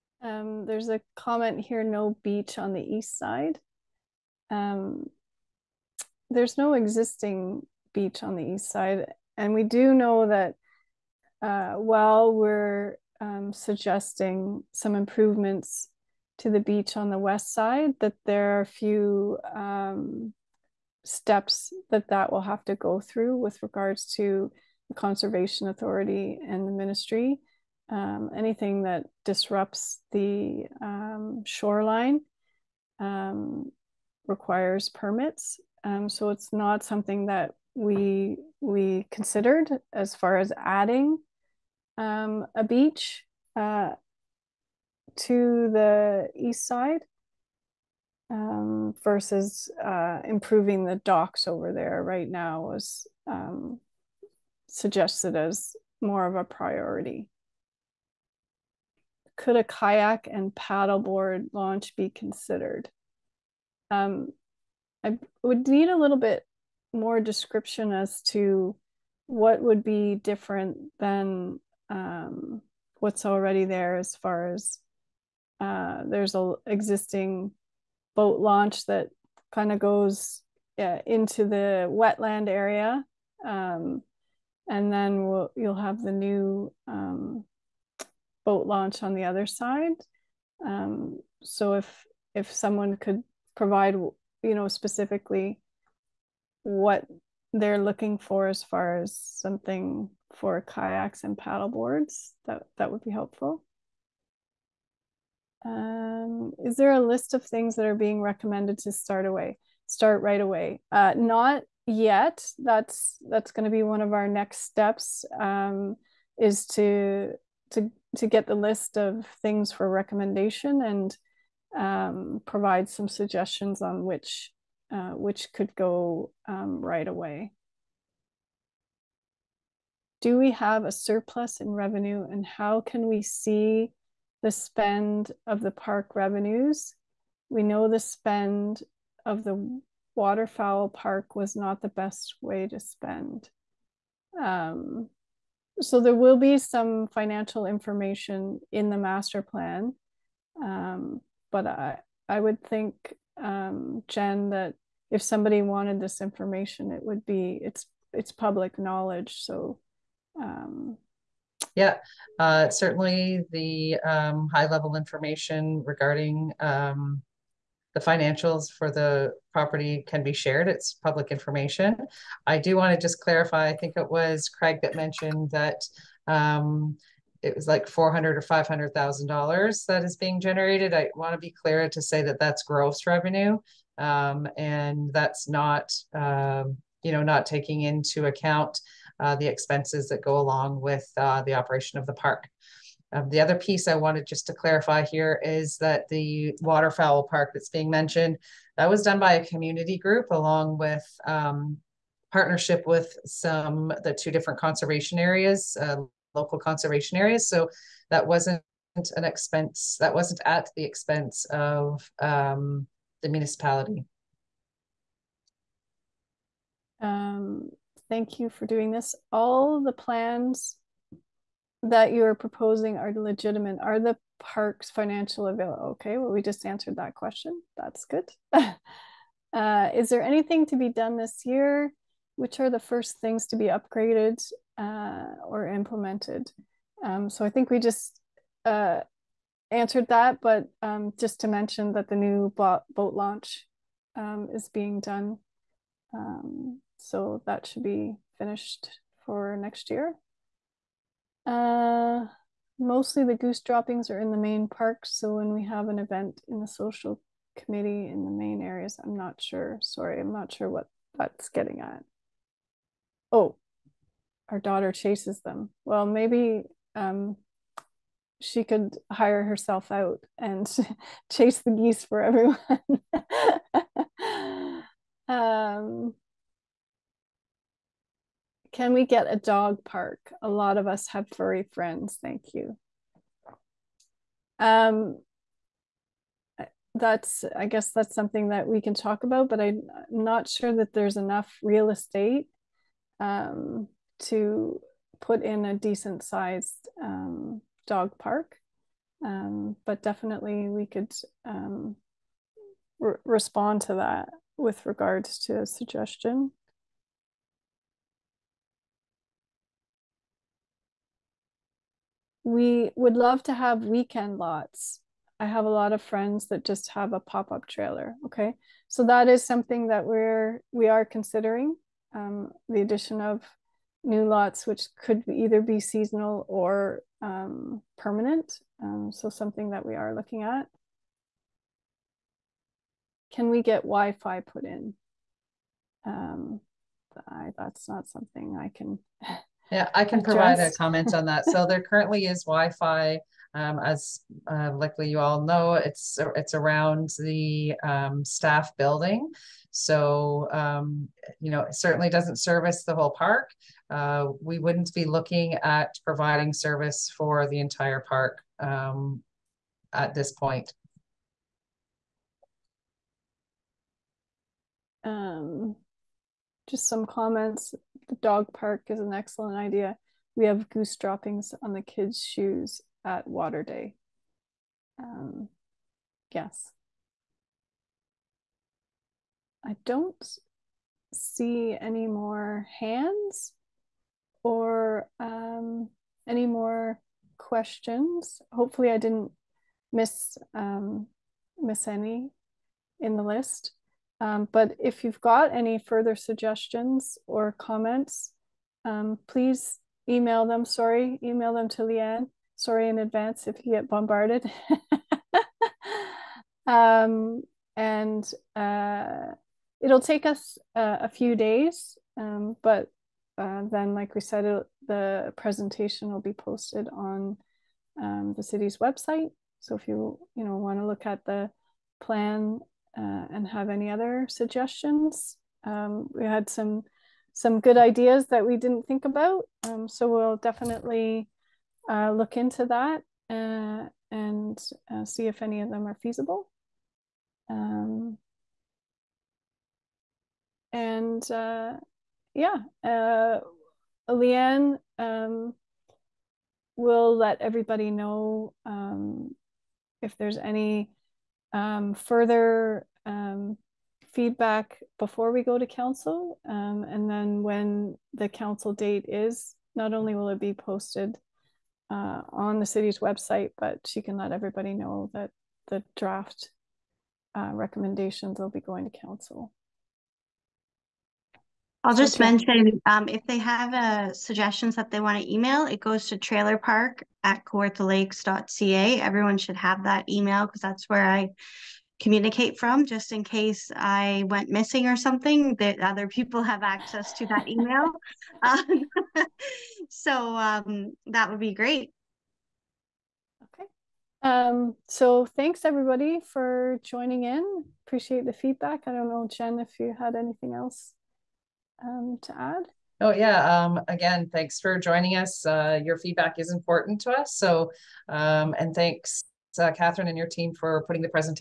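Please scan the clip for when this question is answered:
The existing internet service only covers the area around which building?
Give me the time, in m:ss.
5:48.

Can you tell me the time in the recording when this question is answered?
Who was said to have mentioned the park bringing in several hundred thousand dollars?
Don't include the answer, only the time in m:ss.
2:54.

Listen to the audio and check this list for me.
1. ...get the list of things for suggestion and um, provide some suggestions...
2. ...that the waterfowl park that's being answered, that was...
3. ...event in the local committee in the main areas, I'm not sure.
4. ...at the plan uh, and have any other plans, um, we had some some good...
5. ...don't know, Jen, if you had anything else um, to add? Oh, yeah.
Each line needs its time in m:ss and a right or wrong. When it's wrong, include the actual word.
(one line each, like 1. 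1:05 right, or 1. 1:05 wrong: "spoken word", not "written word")
1. 1:58 wrong: "recommendation", not "suggestion"
2. 3:15 wrong: "mentioned", not "answered"
3. 4:15 wrong: "social", not "local"
4. 7:01 wrong: "suggestions", not "plans"
5. 8:18 right.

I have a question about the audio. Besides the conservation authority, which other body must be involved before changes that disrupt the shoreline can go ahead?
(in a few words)
the ministry.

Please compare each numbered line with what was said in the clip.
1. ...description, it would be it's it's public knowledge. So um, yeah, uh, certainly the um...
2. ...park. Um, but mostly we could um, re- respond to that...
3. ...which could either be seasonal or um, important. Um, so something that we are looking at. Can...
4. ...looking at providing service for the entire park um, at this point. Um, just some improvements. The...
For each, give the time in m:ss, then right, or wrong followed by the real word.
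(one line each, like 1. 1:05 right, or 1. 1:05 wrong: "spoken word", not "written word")
1. 2:36 wrong: "information", not "description"
2. 4:58 wrong: "definitely", not "mostly"
3. 5:24 wrong: "permanent", not "important"
4. 5:55 wrong: "comments", not "improvements".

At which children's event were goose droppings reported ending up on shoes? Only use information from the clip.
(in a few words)
Water Day.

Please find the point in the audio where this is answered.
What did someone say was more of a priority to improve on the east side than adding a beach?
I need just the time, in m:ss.
0:50.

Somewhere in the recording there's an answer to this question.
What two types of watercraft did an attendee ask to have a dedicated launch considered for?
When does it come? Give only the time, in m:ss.
0:59.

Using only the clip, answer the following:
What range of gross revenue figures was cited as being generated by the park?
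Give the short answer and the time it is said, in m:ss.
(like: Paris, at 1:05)
400 or 500 thousand dollars, at 2:57.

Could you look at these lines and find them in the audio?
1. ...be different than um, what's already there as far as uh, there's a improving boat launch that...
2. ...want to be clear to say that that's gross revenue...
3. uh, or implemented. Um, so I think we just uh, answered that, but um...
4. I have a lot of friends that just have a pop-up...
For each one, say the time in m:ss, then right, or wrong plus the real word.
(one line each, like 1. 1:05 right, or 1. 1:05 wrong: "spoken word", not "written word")
1. 1:09 wrong: "existing", not "improving"
2. 3:01 right
3. 3:54 right
4. 5:15 right.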